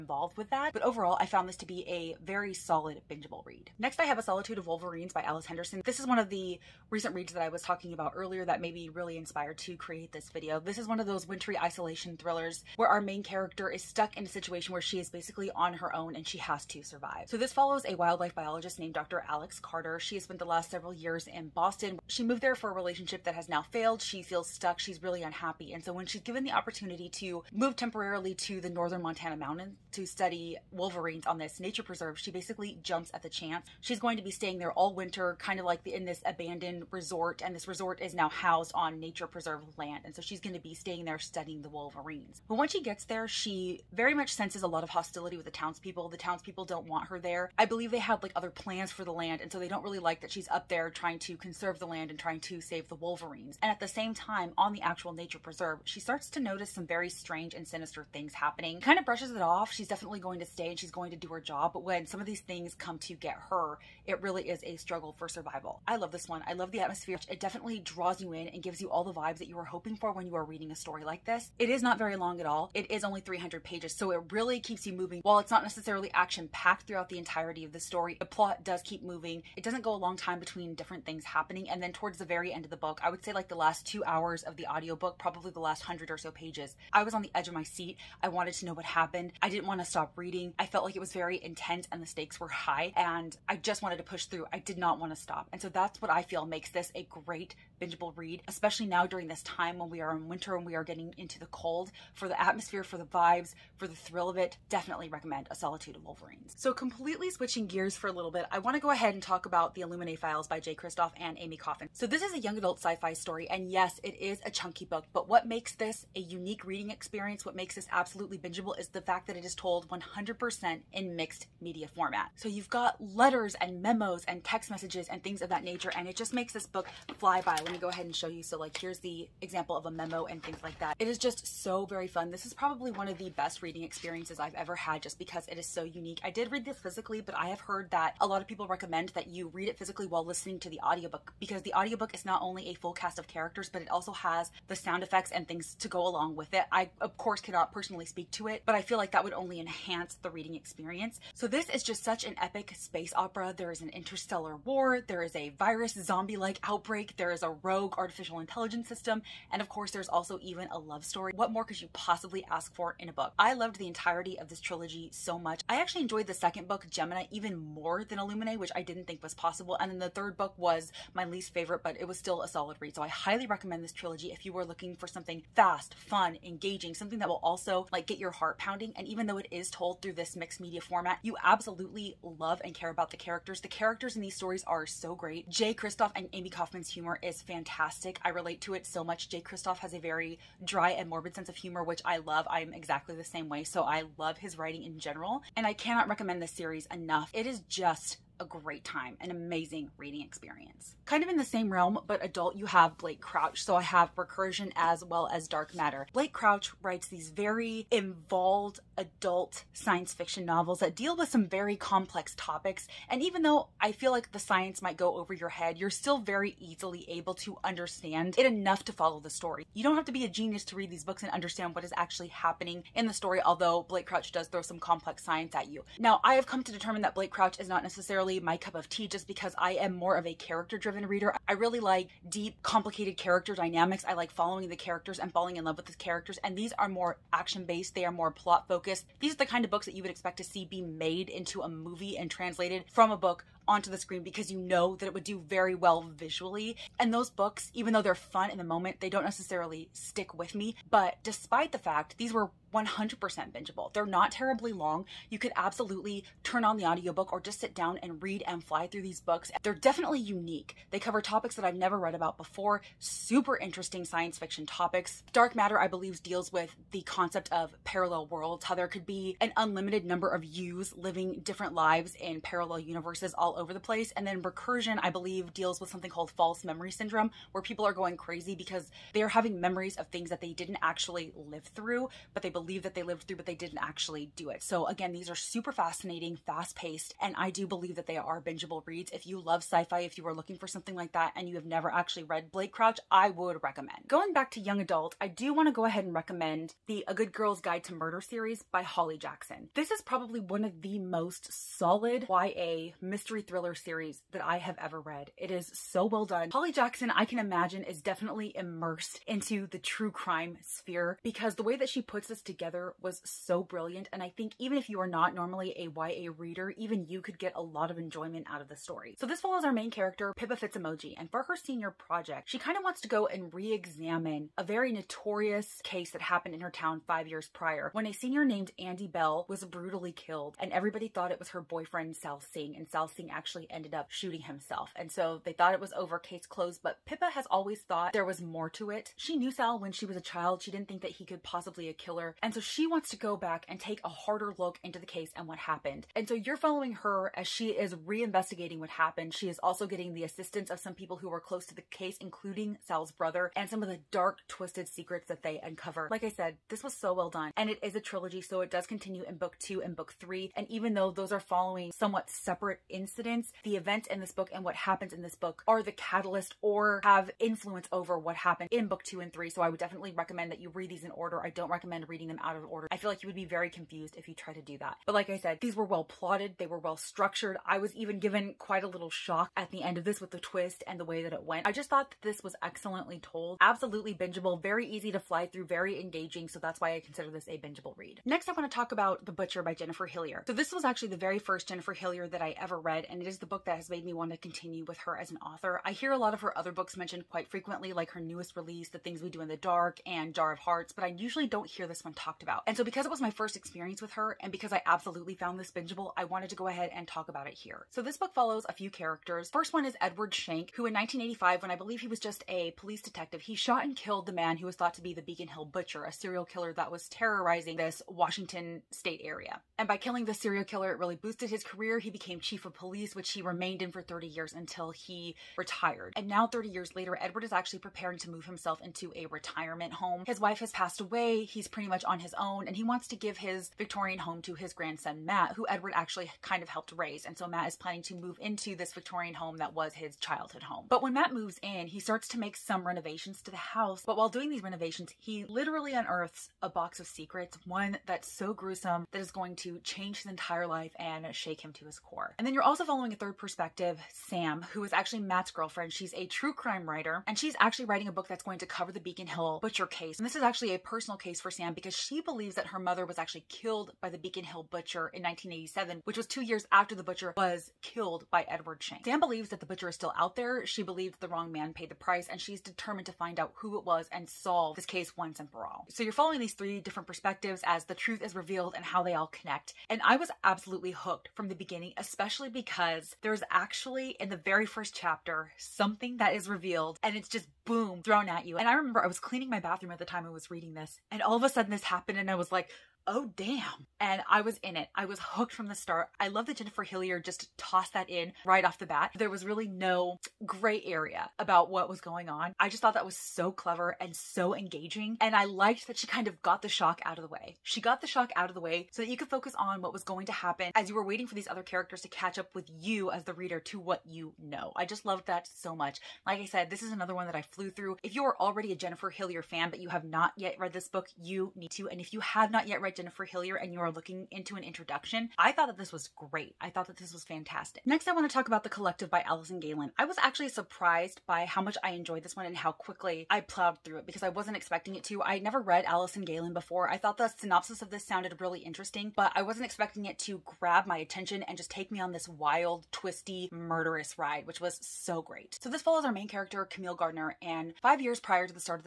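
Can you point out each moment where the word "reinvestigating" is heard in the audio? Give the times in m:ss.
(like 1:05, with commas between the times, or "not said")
5:47.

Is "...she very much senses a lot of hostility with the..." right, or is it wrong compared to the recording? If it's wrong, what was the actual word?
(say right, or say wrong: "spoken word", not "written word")
right.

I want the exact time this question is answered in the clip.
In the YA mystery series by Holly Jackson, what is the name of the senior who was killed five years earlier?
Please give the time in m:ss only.
5:28.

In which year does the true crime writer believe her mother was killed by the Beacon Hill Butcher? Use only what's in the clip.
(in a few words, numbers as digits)
1987.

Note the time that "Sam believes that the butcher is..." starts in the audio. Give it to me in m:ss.
7:49.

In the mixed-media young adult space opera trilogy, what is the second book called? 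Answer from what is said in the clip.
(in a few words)
Gemini.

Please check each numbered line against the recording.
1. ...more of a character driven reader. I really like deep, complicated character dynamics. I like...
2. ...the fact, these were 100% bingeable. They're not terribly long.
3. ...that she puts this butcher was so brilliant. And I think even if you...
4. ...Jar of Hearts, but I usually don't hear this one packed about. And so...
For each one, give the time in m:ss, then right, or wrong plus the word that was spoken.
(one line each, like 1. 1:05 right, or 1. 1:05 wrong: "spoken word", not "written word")
1. 3:49 right
2. 4:11 right
3. 5:11 wrong: "together", not "butcher"
4. 6:40 wrong: "talked", not "packed".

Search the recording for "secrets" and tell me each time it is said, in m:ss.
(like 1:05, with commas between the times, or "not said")
5:54, 7:27.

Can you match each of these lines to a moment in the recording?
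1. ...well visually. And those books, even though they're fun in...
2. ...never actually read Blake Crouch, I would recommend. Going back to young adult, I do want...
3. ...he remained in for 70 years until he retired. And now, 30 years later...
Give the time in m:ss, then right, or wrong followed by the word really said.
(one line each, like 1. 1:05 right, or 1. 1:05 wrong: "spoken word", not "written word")
1. 4:05 right
2. 4:51 right
3. 7:03 wrong: "30", not "70".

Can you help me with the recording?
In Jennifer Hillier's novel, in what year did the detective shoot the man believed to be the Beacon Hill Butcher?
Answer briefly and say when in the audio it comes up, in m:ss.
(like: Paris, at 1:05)
1985, at 6:50.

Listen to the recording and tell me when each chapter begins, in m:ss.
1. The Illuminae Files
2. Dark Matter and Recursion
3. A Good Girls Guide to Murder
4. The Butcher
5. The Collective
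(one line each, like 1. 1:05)
1. 1:46
2. 3:21
3. 4:54
4. 6:28
5. 8:47.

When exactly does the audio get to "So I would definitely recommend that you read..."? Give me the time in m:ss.
6:09.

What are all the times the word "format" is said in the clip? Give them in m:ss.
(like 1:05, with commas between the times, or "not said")
2:01, 3:00.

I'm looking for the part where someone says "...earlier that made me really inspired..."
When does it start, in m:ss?
0:08.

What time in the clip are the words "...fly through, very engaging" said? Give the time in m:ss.
6:25.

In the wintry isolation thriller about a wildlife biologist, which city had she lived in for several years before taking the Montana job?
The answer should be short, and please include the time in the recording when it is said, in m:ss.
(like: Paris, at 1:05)
Boston, at 0:21.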